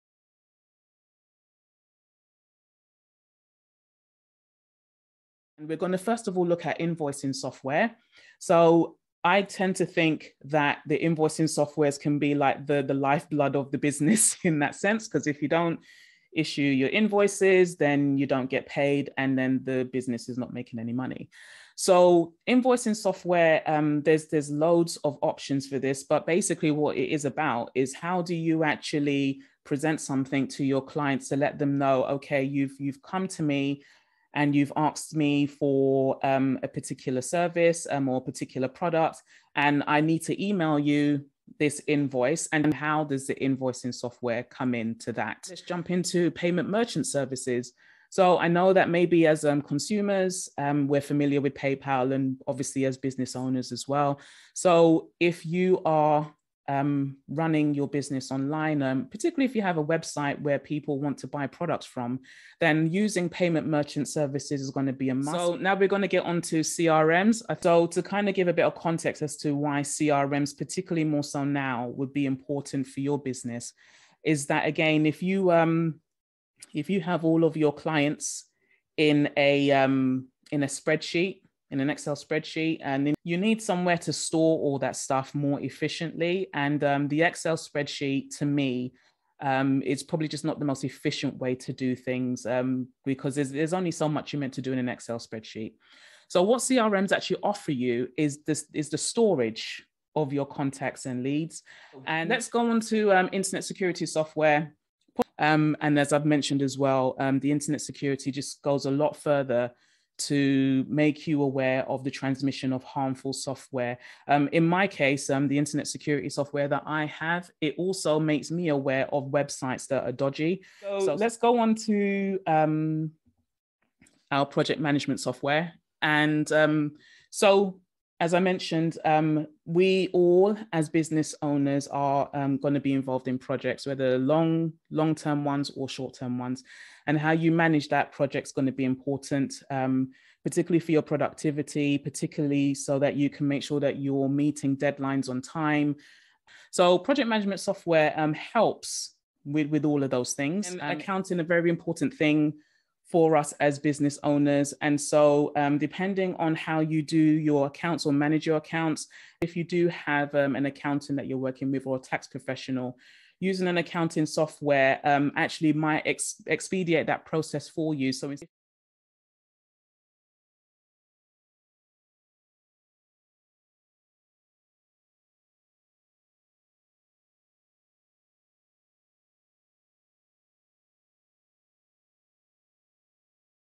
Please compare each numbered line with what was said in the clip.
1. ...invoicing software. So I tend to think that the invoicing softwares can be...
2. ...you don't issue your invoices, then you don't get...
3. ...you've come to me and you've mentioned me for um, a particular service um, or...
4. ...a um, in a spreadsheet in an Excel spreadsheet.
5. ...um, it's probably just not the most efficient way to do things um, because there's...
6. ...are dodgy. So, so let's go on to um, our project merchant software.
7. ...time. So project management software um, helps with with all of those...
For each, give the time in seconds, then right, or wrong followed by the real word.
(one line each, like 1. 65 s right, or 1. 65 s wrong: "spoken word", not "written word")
1. 6 s right
2. 15 s right
3. 32 s wrong: "asked", not "mentioned"
4. 79 s right
5. 89 s right
6. 120 s wrong: "management", not "merchant"
7. 145 s right.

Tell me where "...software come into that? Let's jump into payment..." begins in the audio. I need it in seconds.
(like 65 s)
43 s.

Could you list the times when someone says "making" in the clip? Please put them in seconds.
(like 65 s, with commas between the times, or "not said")
20 s.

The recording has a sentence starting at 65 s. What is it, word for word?
So now we're going to get on to CRMs.